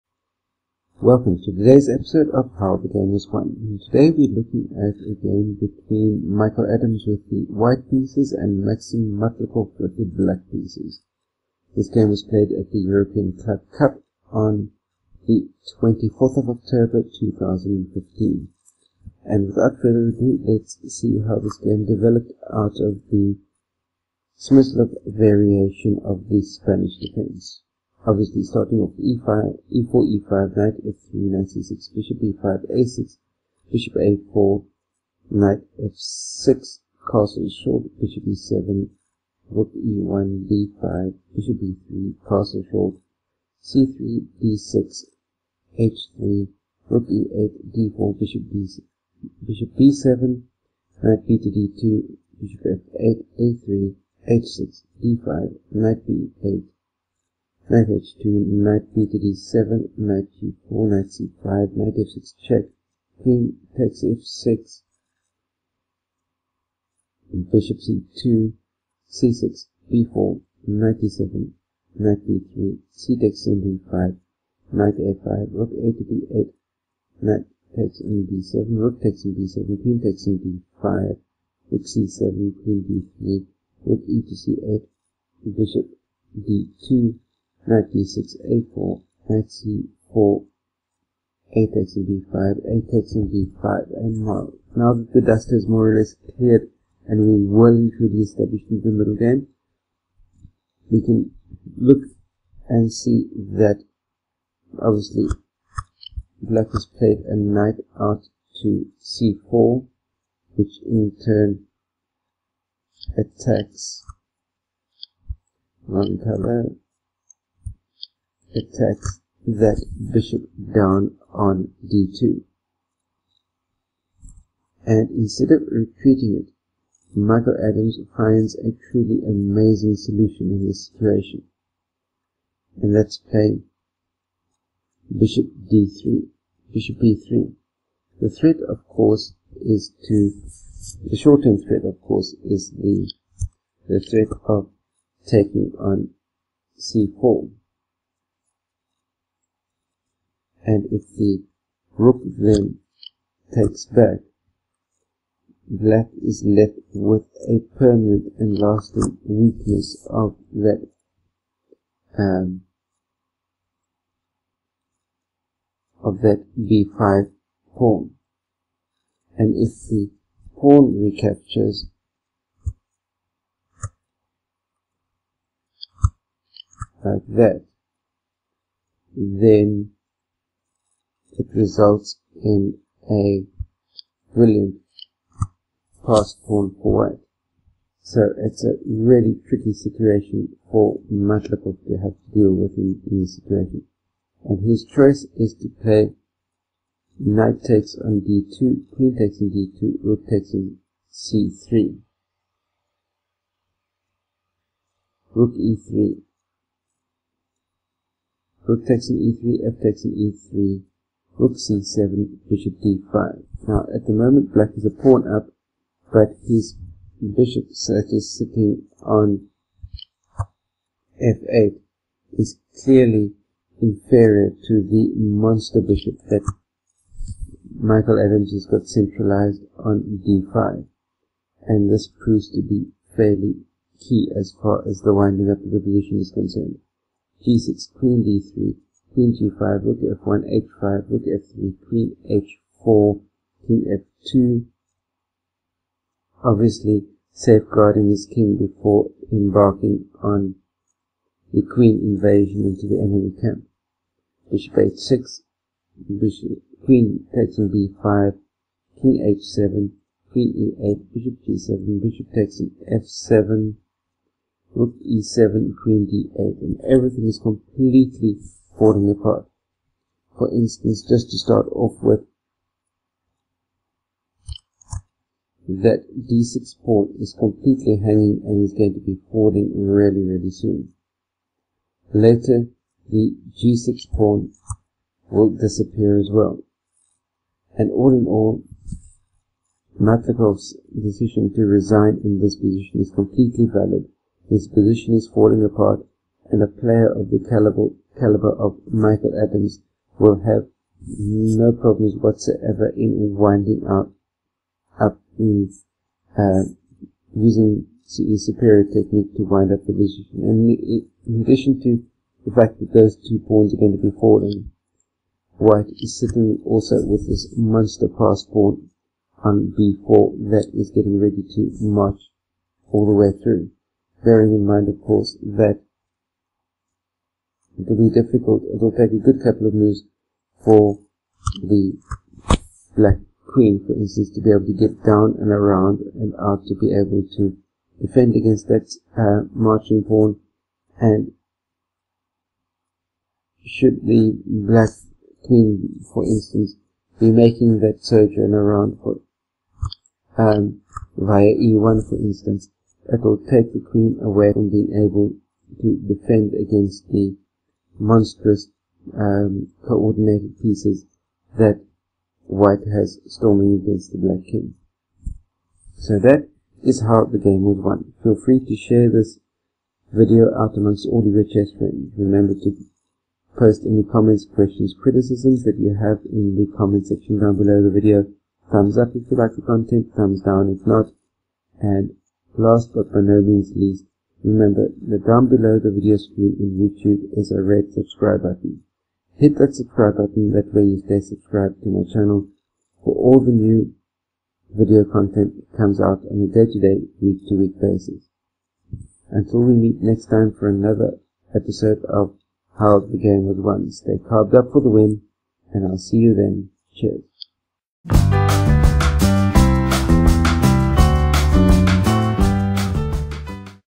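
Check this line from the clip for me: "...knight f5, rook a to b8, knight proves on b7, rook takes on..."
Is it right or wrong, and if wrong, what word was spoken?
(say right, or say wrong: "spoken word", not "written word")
wrong: "takes", not "proves".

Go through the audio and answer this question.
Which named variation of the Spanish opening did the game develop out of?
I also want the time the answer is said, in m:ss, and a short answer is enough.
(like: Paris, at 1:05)
Smyslov variation, at 0:24.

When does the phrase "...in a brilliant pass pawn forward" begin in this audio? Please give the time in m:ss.
3:02.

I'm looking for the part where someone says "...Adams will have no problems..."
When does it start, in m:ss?
4:59.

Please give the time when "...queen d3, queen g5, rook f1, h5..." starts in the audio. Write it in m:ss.
3:57.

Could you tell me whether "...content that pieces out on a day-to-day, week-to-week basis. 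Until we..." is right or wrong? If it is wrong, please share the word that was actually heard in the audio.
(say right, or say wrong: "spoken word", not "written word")
wrong: "comes", not "pieces".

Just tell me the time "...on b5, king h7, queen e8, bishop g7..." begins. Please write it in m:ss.
4:17.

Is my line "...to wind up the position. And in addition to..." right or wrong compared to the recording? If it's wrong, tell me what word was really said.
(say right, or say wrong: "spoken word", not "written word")
right.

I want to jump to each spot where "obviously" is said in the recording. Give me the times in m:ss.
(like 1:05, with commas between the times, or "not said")
0:28, 1:44, 4:06.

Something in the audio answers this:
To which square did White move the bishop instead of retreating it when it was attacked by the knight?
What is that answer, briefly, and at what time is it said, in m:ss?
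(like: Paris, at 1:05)
b3, at 2:16.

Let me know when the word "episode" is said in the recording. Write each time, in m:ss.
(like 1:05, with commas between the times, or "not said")
0:01, 6:41.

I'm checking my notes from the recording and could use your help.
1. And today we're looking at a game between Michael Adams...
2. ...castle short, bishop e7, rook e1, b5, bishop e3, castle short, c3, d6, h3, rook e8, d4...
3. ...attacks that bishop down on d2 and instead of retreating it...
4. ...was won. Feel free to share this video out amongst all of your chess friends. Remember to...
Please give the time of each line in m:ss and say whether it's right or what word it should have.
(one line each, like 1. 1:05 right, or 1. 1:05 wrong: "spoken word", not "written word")
1. 0:03 right
2. 0:37 right
3. 1:58 right
4. 6:07 right.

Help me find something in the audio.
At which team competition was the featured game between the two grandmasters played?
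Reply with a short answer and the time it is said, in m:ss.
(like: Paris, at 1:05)
European Club Cup, at 0:12.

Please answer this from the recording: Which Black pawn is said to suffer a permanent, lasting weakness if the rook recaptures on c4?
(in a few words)
b5 pawn.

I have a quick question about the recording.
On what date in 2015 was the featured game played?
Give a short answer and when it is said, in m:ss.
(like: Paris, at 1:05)
24 October 2015, at 0:15.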